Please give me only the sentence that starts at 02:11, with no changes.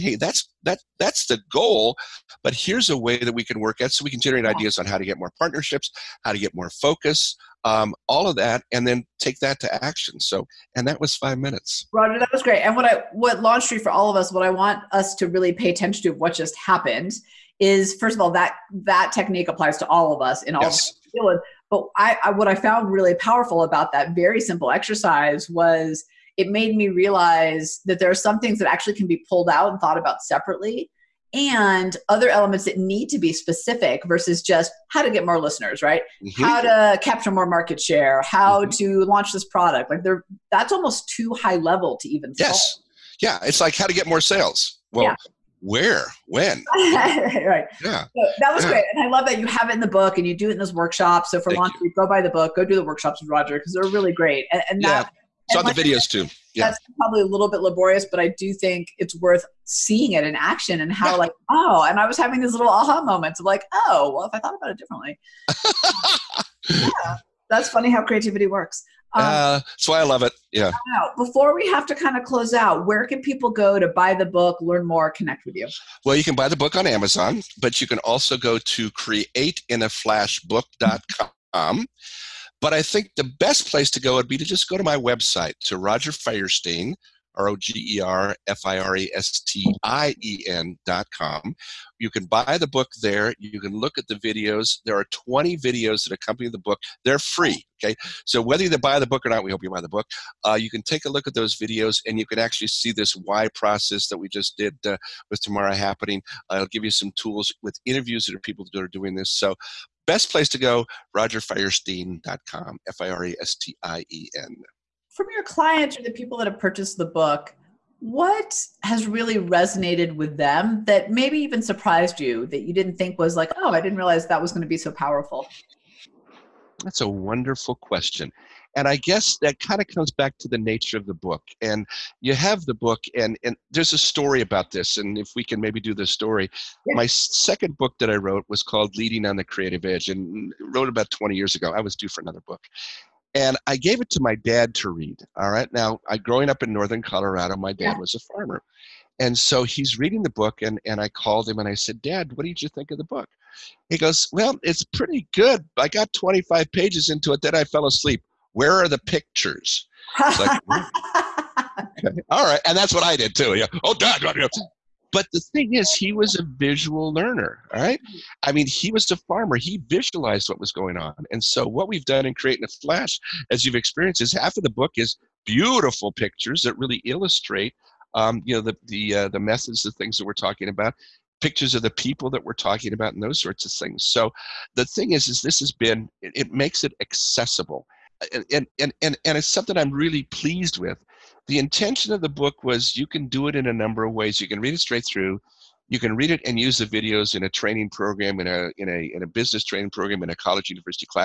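And you have the book, and, and there's a story about this.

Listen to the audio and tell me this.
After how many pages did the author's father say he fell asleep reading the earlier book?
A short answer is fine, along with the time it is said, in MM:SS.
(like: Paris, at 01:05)
25, at 02:36.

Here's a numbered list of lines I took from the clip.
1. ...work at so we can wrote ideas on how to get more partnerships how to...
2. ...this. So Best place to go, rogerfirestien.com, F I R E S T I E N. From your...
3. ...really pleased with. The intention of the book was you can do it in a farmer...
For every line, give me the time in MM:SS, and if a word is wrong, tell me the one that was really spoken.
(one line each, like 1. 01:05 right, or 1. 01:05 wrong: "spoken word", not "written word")
1. 00:03 wrong: "generate", not "wrote"
2. 01:49 right
3. 03:09 wrong: "number", not "farmer".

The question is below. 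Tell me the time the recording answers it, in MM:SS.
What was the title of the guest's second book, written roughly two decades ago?
02:18.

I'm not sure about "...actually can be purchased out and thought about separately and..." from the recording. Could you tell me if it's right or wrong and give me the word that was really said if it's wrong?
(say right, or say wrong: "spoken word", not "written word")
wrong: "pulled", not "purchased".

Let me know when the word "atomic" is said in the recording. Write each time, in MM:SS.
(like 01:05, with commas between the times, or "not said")
not said.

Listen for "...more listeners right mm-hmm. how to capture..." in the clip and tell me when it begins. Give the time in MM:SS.
00:35.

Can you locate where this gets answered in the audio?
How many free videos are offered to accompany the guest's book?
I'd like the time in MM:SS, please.
01:35.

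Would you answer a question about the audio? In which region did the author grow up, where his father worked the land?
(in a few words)
Northern Colorado.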